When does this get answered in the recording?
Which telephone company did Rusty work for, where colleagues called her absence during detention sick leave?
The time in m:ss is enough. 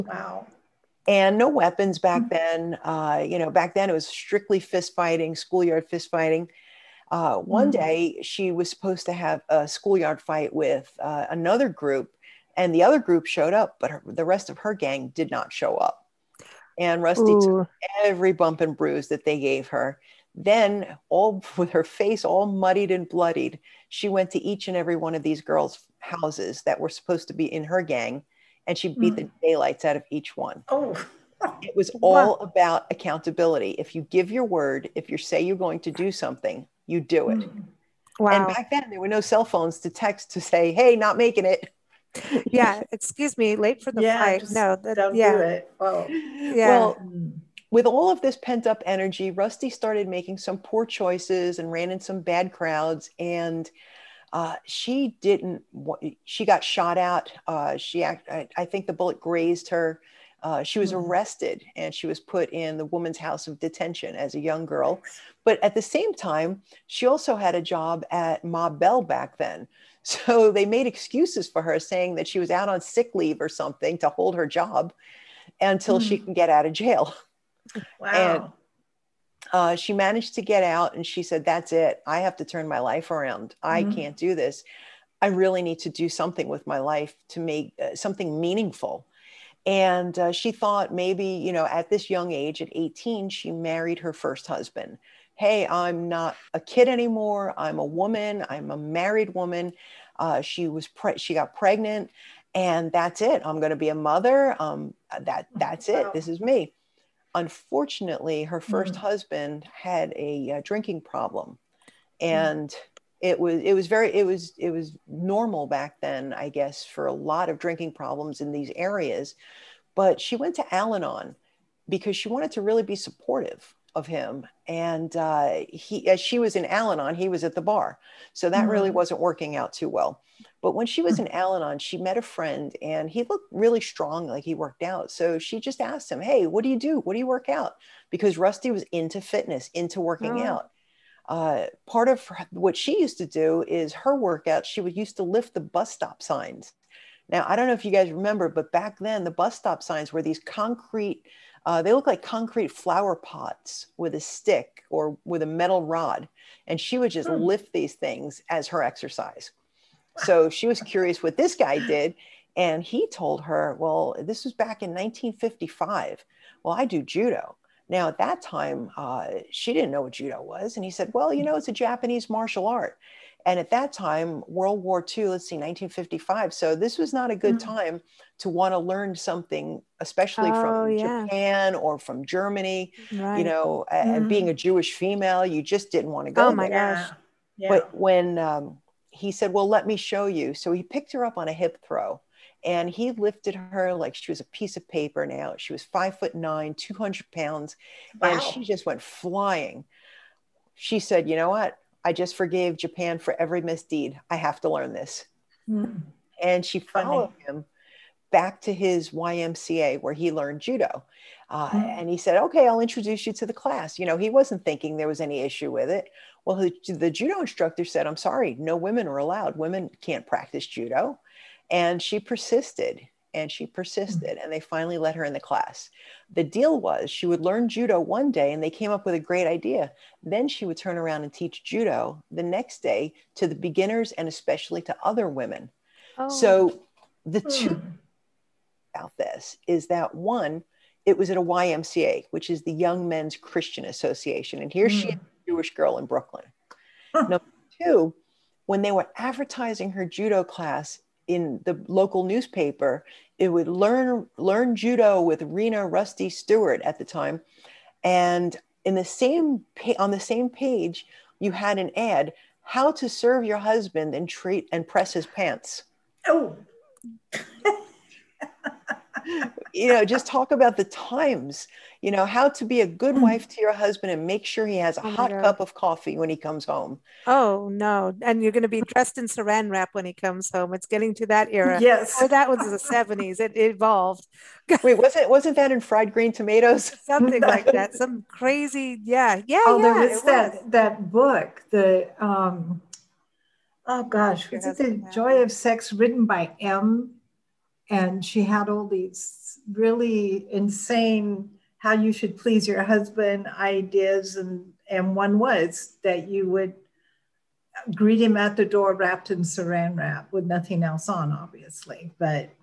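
1:08.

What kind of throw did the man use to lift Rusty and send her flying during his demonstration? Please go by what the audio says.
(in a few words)
hip throw.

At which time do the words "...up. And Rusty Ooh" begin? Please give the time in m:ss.
0:15.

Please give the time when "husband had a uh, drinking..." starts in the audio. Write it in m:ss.
1:48.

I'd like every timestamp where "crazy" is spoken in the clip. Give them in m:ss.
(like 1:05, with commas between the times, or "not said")
4:48.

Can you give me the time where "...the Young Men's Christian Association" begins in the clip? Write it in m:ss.
4:02.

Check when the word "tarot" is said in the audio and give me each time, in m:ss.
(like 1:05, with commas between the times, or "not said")
not said.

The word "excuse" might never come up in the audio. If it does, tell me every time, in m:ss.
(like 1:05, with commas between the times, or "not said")
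0:42, 1:10.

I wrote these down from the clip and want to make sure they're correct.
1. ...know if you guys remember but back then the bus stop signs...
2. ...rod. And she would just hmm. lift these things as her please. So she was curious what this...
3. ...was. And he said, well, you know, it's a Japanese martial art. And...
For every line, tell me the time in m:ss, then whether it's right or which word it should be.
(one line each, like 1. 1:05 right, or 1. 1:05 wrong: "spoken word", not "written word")
1. 2:27 right
2. 2:35 wrong: "exercise", not "please"
3. 2:50 right.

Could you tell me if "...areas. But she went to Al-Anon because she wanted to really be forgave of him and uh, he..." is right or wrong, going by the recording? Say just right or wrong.
wrong.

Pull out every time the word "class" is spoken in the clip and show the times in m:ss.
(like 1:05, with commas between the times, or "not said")
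3:33, 3:45, 4:10.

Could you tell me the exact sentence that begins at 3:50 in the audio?
Then she would turn around and teach judo the next day to the beginners and especially to other women.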